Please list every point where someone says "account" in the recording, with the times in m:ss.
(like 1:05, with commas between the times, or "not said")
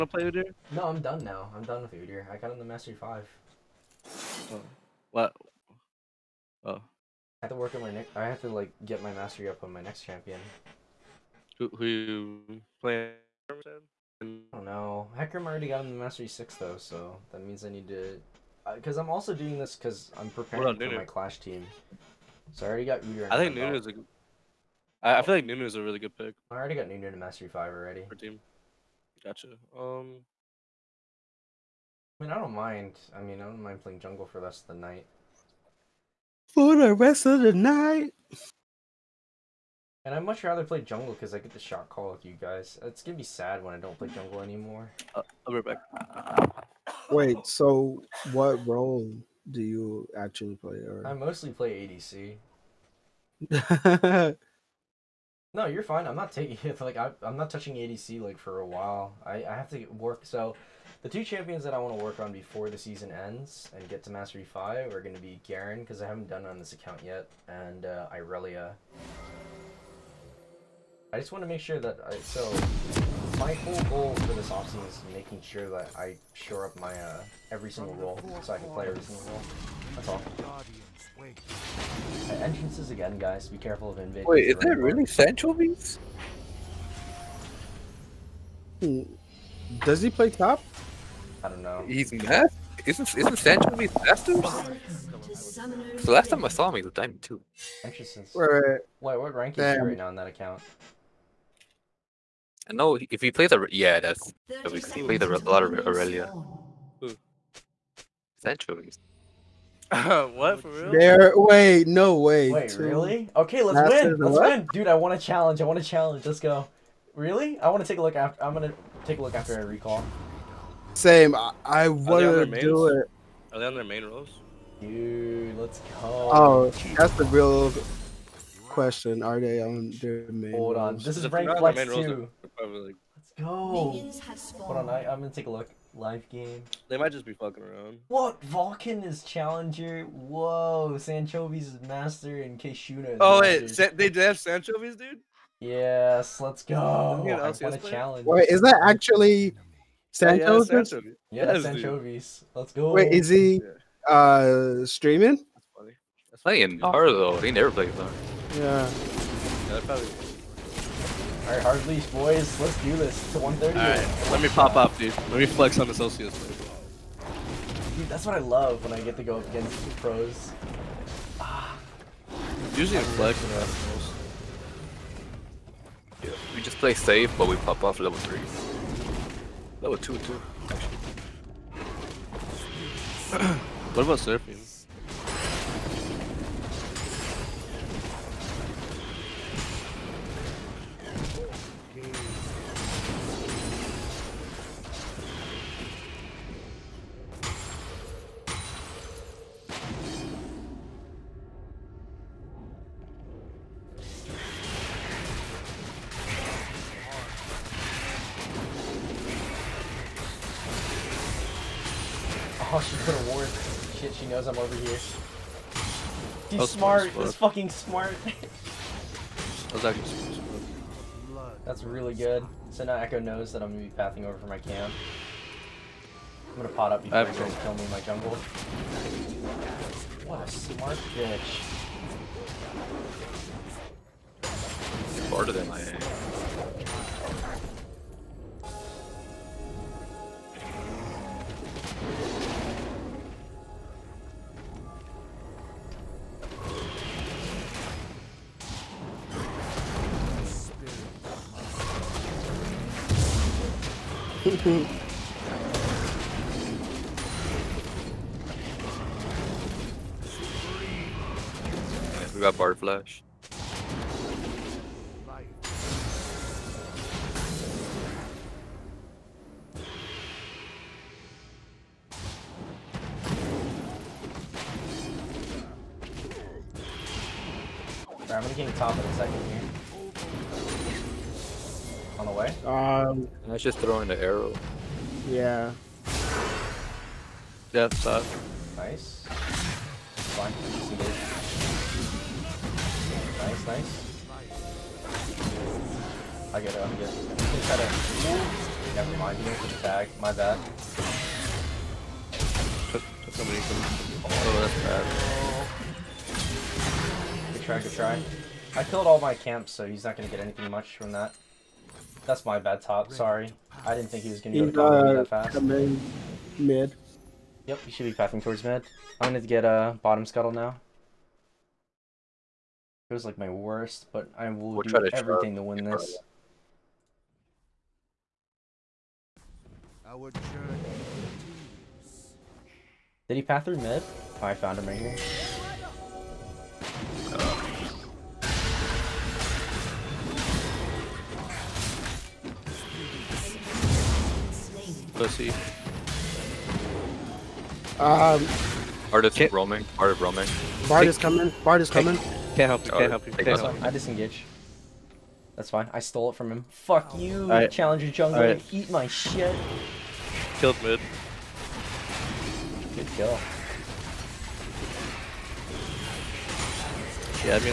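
1:06, 1:40.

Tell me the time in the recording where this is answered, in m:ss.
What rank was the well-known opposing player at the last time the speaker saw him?
1:36.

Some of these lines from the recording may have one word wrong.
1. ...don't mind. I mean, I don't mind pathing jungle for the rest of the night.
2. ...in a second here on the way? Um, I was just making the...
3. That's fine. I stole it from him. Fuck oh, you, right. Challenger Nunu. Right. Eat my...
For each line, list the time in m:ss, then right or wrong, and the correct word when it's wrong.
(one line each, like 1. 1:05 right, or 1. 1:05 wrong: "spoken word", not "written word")
1. 0:32 wrong: "playing", not "pathing"
2. 4:38 wrong: "throwing", not "making"
3. 5:55 wrong: "Jungle", not "Nunu".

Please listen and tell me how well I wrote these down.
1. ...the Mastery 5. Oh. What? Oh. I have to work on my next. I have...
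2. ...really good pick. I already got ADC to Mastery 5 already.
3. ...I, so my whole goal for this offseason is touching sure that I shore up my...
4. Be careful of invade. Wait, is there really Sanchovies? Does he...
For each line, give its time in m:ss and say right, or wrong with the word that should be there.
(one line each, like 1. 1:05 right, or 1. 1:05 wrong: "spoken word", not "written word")
1. 0:02 right
2. 0:25 wrong: "Nunu", not "ADC"
3. 1:12 wrong: "making", not "touching"
4. 1:23 right.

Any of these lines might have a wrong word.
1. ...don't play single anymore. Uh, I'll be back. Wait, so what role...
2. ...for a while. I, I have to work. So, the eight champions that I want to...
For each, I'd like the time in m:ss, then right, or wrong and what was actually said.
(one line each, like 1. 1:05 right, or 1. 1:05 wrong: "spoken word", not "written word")
1. 0:43 wrong: "jungle", not "single"
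2. 0:58 wrong: "two", not "eight".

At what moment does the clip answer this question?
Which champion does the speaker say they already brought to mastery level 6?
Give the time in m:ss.
0:15.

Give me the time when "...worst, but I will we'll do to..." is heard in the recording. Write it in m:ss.
5:23.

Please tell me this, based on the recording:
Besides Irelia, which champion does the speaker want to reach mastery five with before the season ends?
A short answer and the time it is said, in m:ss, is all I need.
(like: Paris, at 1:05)
Garen, at 1:05.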